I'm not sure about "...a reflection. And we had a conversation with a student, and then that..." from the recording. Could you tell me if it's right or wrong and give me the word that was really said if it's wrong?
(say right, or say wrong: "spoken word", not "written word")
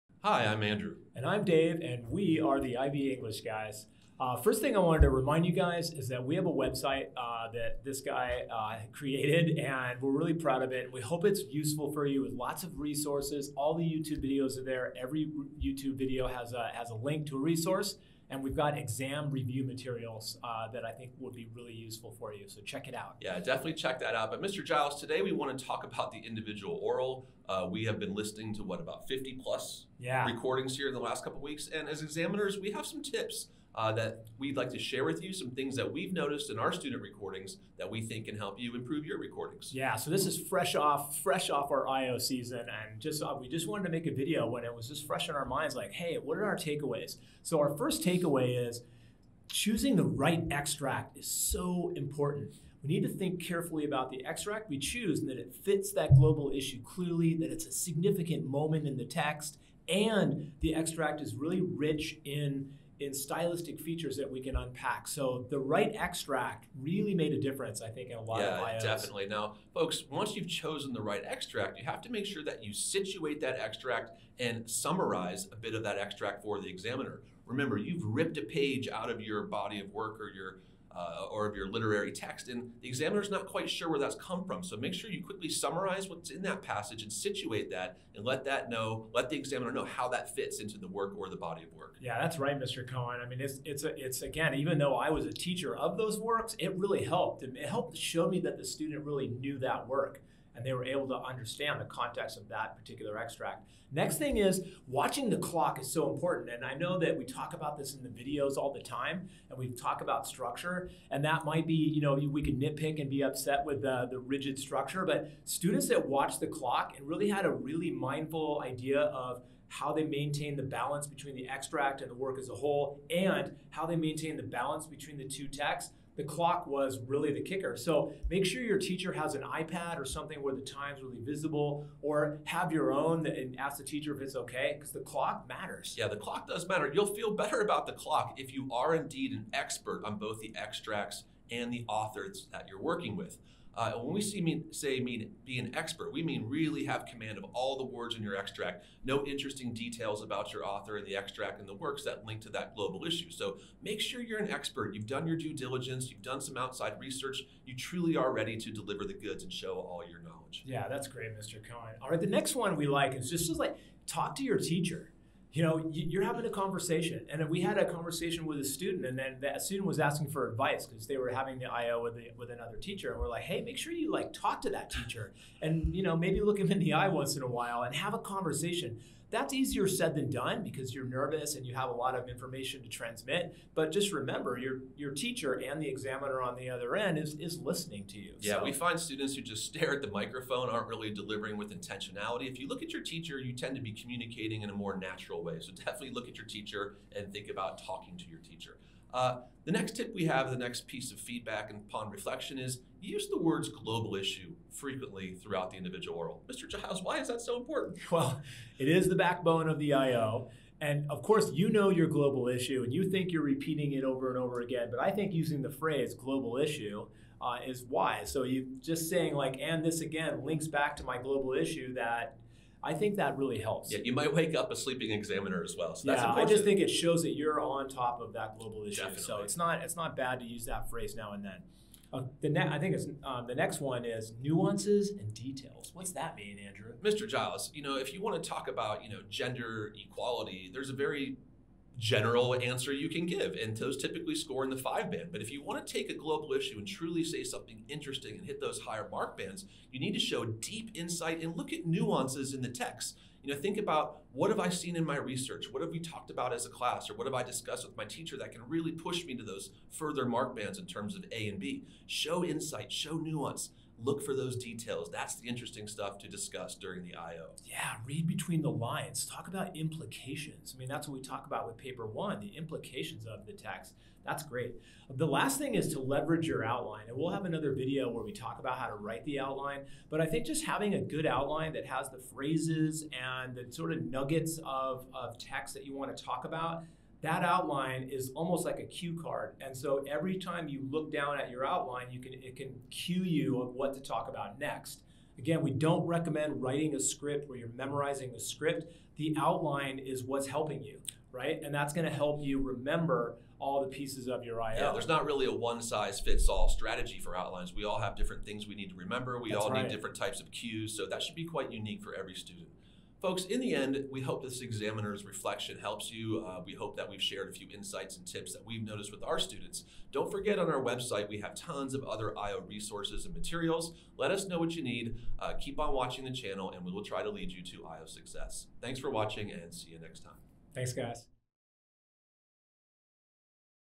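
wrong: "conversation", not "reflection".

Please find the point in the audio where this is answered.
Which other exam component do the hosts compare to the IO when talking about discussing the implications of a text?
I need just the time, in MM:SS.
04:31.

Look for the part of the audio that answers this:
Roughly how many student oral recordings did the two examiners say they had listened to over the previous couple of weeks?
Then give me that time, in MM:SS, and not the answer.
00:29.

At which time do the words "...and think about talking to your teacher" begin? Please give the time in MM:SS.
03:17.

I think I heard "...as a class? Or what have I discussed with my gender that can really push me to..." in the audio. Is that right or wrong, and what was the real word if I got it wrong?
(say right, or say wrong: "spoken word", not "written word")
wrong: "teacher", not "gender".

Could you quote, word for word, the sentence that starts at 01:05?
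So the right extract really made a difference, I think, in a lot yeah, of IOs.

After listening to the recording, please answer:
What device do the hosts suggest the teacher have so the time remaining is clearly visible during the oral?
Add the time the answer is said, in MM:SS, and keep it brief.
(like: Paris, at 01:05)
iPad, at 02:09.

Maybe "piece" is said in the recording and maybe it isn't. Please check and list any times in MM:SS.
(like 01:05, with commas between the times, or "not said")
03:20, 05:03.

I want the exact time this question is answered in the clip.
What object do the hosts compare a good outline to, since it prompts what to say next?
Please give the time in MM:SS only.
04:48.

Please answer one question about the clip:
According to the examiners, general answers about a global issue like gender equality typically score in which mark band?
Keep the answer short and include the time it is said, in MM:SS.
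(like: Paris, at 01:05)
five band, at 04:04.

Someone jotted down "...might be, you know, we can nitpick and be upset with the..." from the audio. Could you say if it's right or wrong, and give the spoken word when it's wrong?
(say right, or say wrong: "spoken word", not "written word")
right.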